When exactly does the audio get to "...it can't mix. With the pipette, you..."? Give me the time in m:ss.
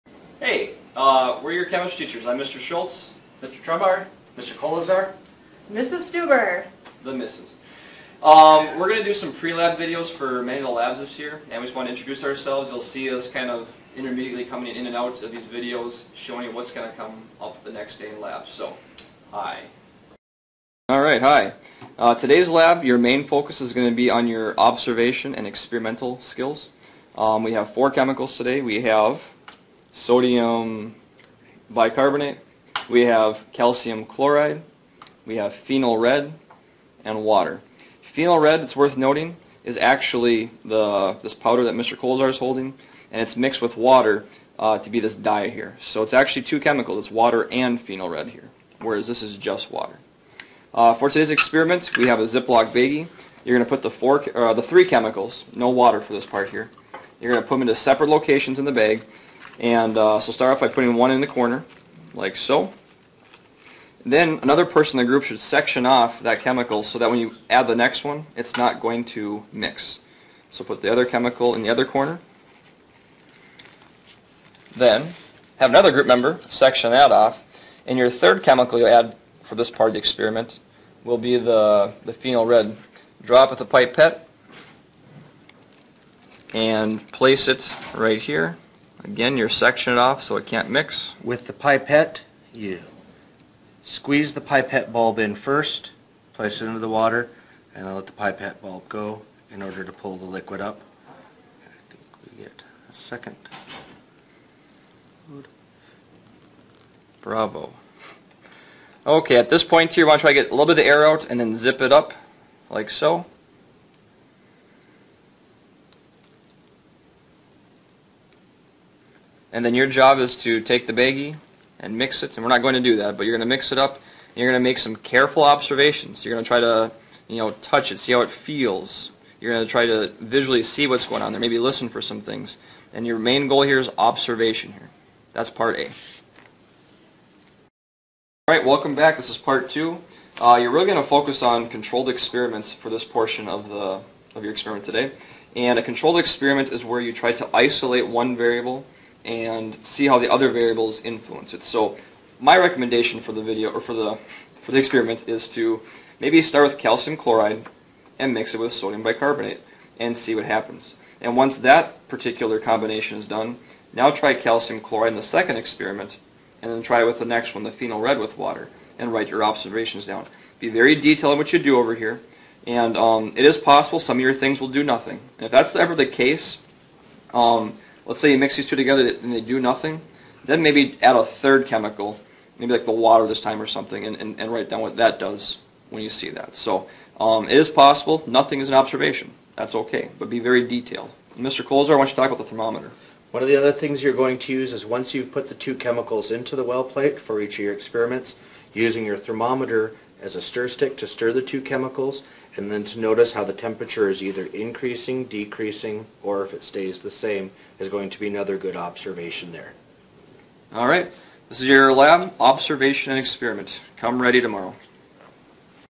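1:30.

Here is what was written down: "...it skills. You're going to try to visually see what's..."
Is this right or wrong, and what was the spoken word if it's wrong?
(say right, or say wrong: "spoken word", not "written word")
wrong: "feels", not "skills".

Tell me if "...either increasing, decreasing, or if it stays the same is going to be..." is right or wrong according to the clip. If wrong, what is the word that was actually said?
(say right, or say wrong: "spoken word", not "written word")
right.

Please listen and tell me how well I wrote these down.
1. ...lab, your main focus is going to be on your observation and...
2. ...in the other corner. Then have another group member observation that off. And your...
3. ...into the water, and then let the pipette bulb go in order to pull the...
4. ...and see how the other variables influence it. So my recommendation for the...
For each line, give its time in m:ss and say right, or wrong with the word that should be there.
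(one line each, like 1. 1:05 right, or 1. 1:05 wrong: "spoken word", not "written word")
1. 0:22 right
2. 1:11 wrong: "section", not "observation"
3. 1:36 right
4. 2:29 right.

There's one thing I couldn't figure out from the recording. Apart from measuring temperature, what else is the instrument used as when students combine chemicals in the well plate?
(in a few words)
stir stick.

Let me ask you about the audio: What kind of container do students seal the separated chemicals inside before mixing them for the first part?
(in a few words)
Ziploc baggie.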